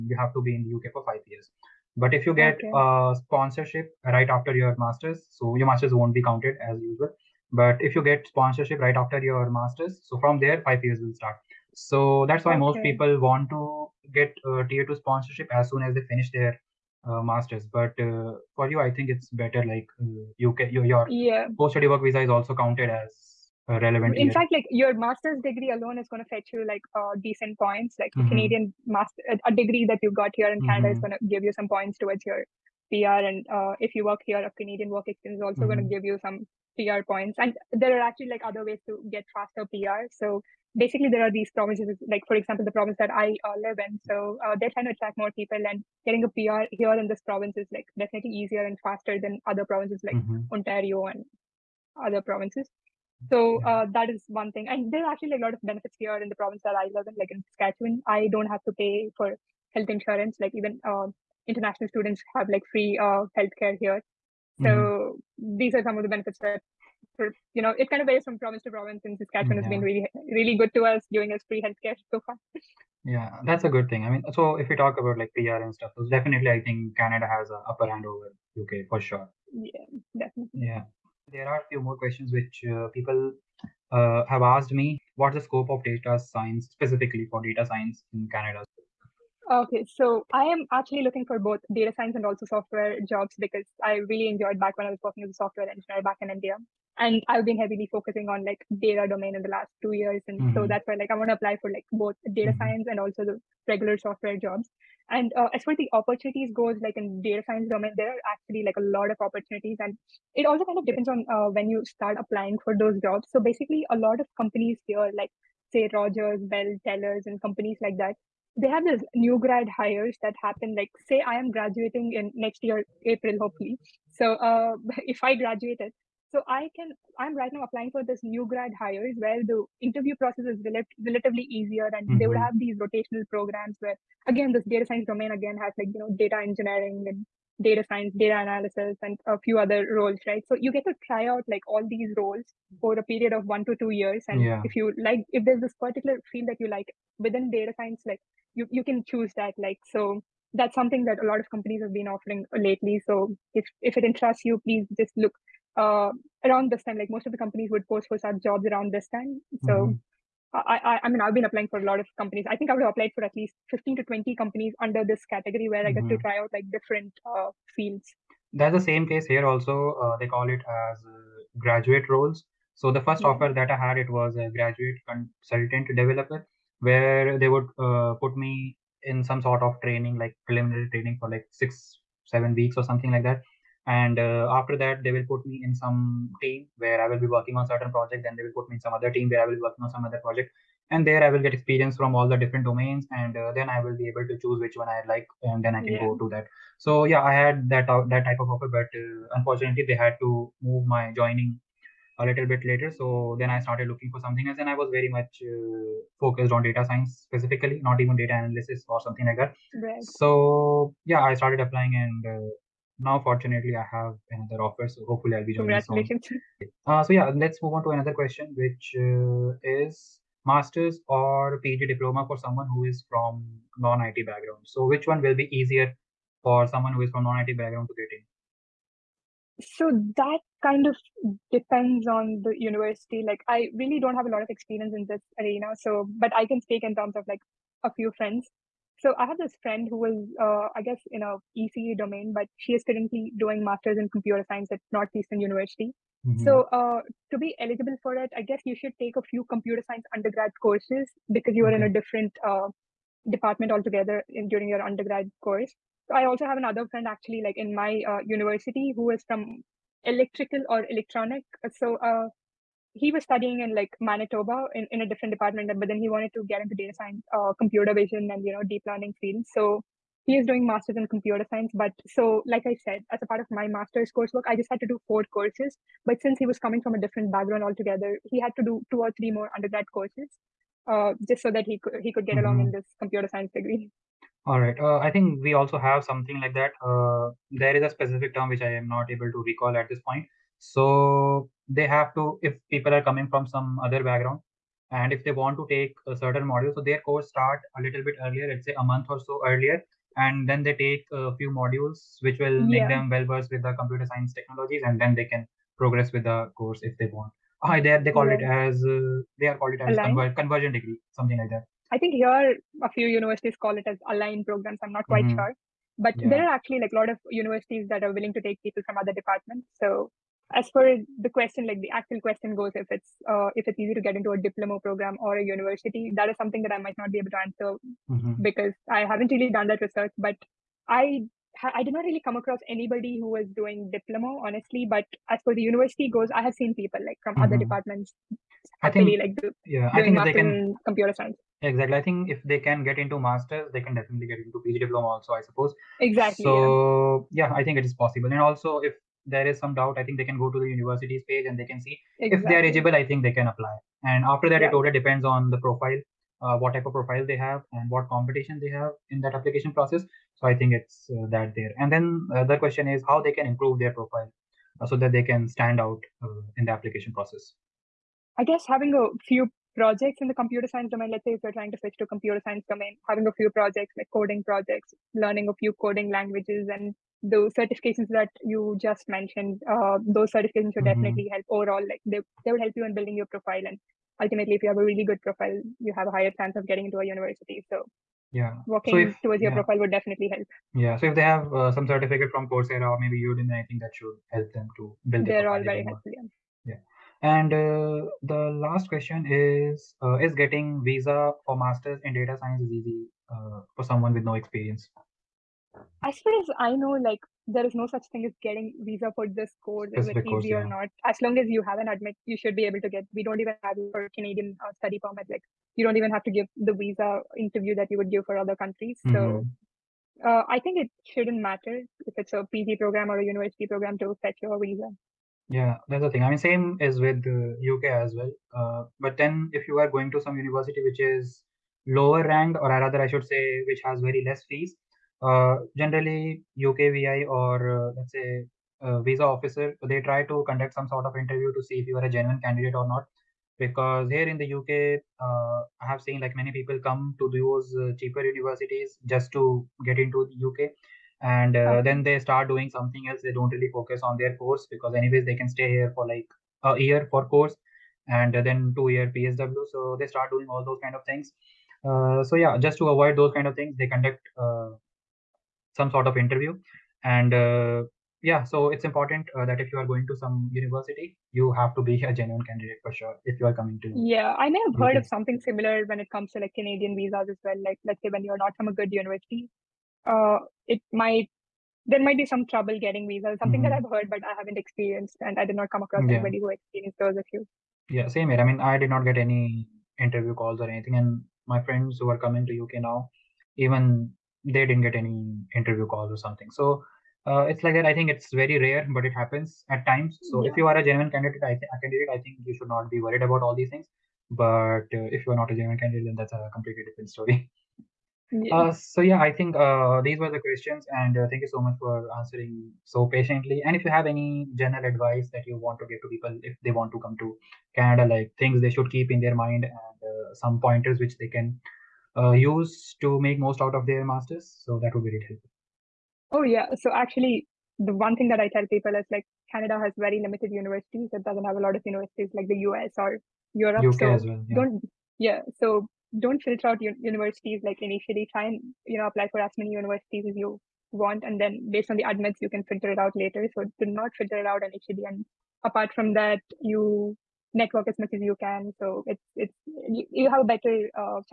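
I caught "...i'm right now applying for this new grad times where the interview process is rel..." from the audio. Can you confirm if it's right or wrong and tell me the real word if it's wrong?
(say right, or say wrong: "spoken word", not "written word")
wrong: "hires", not "times".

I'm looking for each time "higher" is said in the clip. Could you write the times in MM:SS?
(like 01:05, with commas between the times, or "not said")
06:26.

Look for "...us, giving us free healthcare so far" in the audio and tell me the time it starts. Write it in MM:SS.
01:10.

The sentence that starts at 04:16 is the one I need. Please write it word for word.
So I also have another friend actually, like in my uh, university, who is from electrical or electronic.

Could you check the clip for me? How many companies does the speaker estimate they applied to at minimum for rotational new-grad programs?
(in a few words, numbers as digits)
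15.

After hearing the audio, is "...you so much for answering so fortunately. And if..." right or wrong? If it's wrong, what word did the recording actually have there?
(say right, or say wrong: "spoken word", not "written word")
wrong: "patiently", not "fortunately".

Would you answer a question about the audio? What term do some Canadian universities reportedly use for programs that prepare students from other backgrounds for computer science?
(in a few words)
aligned programs.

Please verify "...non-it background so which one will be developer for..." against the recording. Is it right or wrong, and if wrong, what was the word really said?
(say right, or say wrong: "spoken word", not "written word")
wrong: "easier", not "developer".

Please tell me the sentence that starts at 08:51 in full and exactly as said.
It doesn't have a lot of universities like the US or Europe.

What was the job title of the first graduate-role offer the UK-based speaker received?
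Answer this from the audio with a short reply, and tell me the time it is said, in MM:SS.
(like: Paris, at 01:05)
graduate consultant developer, at 02:54.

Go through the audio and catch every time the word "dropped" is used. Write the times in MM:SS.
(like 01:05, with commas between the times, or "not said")
not said.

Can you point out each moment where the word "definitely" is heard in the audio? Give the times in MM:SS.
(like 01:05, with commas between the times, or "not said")
00:47, 01:16, 01:20, 05:43, 06:21, 06:29.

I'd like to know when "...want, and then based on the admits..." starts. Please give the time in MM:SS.
09:00.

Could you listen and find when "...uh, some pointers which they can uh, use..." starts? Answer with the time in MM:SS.
08:40.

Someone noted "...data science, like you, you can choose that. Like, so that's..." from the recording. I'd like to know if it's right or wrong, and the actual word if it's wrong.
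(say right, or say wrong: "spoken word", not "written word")
right.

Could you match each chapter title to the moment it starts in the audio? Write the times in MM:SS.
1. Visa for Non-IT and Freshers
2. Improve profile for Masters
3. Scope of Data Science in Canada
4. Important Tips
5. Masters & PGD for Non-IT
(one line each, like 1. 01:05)
1. 06:39
2. 06:02
3. 01:20
4. 08:33
5. 03:40.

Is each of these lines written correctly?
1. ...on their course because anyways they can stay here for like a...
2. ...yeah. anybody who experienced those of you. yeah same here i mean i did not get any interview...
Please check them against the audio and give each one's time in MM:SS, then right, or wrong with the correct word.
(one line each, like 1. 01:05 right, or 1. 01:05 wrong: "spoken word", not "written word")
1. 07:34 right
2. 08:06 right.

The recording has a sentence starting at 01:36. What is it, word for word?
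And I've been heavily focusing on like data domain in the last two years.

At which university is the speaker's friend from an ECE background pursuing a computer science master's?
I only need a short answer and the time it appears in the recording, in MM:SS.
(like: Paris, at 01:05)
Northeastern University, at 04:04.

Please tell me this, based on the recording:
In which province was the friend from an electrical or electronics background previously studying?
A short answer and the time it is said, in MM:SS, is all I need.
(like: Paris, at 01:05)
Manitoba, at 04:23.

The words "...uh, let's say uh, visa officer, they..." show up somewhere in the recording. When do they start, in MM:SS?
07:17.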